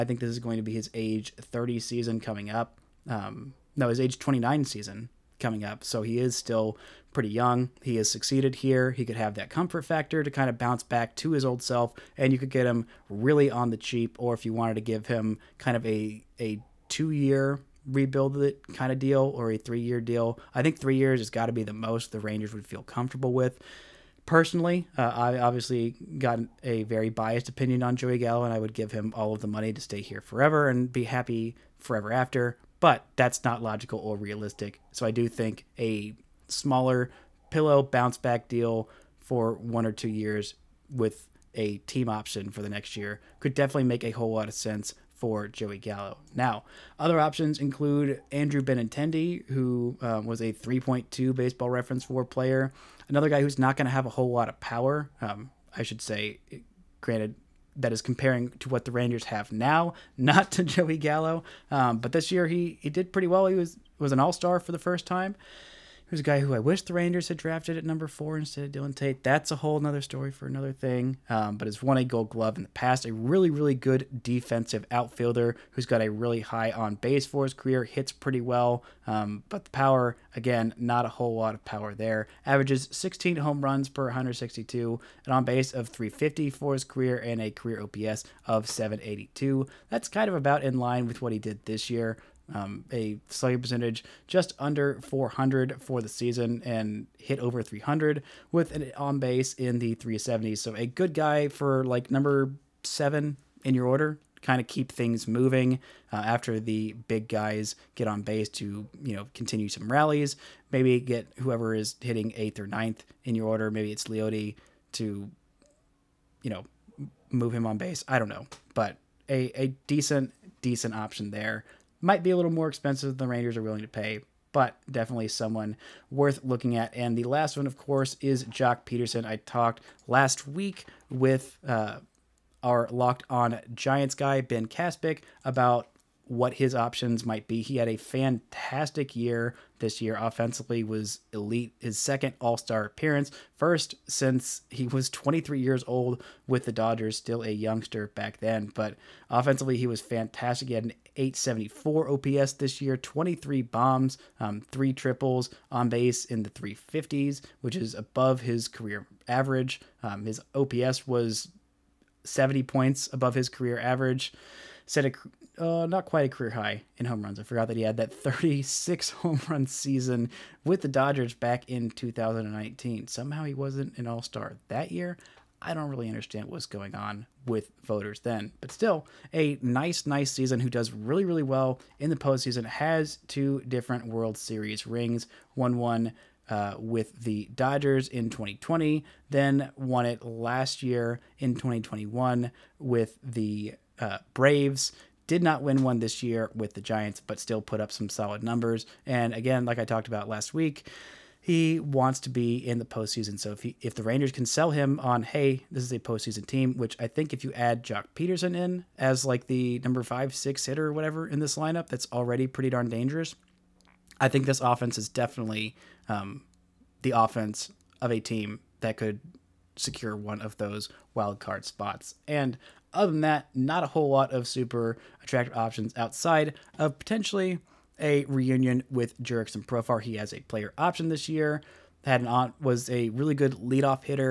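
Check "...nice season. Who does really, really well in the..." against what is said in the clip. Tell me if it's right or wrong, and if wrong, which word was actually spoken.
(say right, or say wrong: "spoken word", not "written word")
right.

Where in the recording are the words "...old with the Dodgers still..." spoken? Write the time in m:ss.
2:25.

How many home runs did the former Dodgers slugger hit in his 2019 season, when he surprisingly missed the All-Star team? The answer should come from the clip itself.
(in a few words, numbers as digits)
36.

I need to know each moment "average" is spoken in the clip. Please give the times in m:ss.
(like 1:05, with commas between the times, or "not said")
1:22, 2:39, 2:43.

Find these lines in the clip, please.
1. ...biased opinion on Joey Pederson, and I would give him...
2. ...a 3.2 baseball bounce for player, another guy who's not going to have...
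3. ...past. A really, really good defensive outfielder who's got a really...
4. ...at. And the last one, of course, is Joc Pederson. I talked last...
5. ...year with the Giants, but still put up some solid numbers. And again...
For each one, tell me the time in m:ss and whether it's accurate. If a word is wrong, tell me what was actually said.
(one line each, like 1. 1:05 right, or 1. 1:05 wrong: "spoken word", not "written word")
1. 0:27 wrong: "Gallo", not "Pederson"
2. 0:50 wrong: "reference", not "bounce"
3. 1:12 right
4. 2:06 right
5. 3:16 right.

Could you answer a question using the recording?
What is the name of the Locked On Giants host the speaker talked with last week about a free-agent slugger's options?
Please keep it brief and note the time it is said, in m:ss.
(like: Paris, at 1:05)
Ben Kaspick, at 2:14.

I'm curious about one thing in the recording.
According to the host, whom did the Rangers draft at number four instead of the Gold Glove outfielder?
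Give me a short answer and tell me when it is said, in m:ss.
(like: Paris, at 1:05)
Dillon Tate, at 1:08.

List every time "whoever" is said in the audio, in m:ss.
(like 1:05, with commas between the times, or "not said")
1:51.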